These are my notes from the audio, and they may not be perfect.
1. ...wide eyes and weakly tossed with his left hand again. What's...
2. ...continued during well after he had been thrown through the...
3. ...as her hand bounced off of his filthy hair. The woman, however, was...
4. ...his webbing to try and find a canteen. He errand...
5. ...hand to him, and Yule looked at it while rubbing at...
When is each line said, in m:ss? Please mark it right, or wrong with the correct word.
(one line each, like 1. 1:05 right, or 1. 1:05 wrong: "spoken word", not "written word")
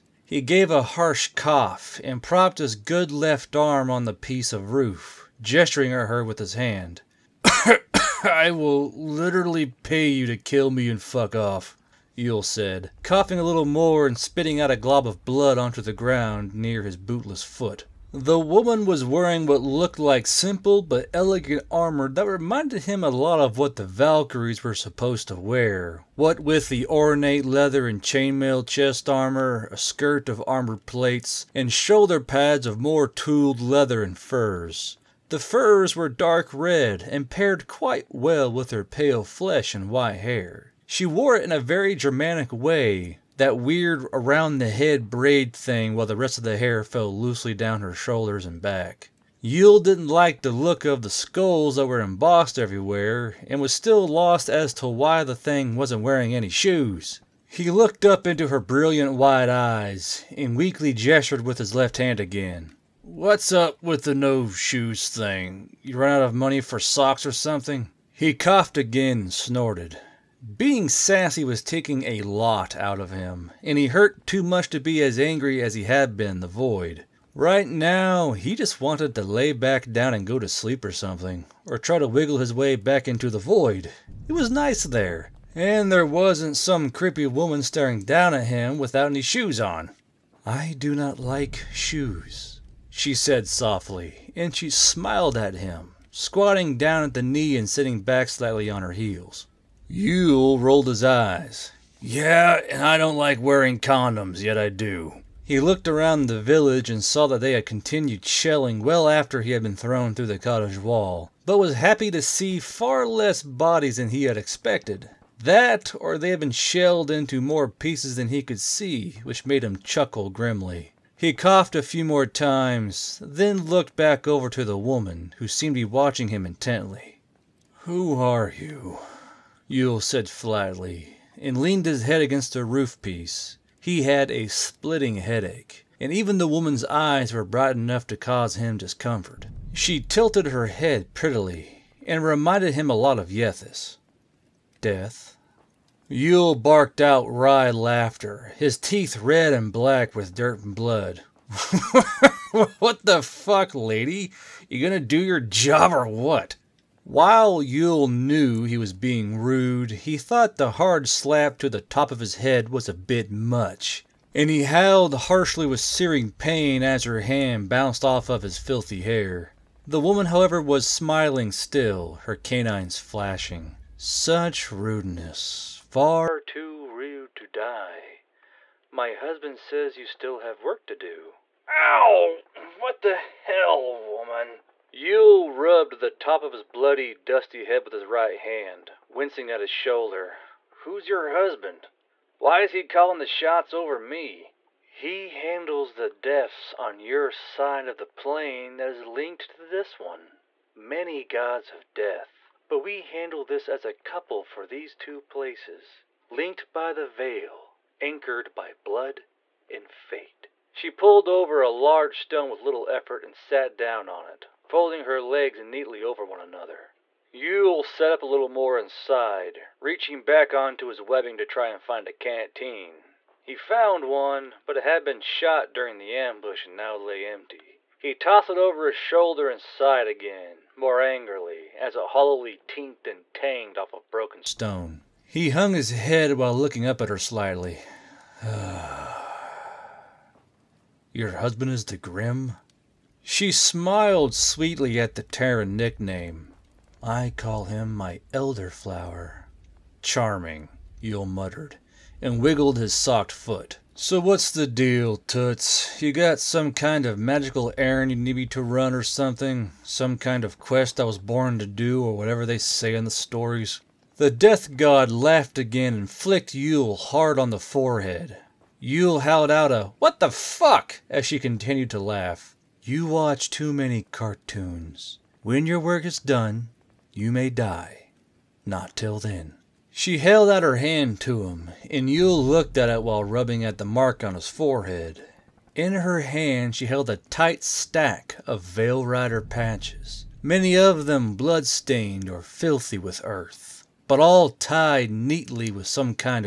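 1. 0:59 wrong: "gestured", not "tossed"
2. 1:47 wrong: "shelling", not "during"
3. 2:46 right
4. 3:40 wrong: "found", not "errand"
5. 4:40 right.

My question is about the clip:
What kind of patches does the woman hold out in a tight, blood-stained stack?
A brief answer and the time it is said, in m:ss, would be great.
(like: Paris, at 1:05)
Veil Rider patches, at 4:48.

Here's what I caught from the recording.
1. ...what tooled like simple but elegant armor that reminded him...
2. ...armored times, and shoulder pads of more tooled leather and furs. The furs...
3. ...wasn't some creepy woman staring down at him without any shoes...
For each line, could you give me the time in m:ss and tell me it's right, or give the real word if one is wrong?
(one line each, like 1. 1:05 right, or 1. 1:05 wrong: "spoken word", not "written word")
1. 0:19 wrong: "looked", not "tooled"
2. 0:30 wrong: "plates", not "times"
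3. 1:26 right.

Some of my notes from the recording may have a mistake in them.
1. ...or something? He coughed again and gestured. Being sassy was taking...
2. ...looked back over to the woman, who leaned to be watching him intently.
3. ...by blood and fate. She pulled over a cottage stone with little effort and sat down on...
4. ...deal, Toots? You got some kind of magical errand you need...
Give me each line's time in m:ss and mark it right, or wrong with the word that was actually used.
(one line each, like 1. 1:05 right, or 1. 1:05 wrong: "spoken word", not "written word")
1. 1:07 wrong: "snorted", not "gestured"
2. 2:03 wrong: "seemed", not "leaned"
3. 3:28 wrong: "large", not "cottage"
4. 4:14 right.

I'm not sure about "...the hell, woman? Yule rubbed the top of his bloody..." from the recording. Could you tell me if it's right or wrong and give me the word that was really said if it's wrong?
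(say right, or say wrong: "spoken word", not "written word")
right.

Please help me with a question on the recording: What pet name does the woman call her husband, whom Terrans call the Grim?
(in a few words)
elderflower.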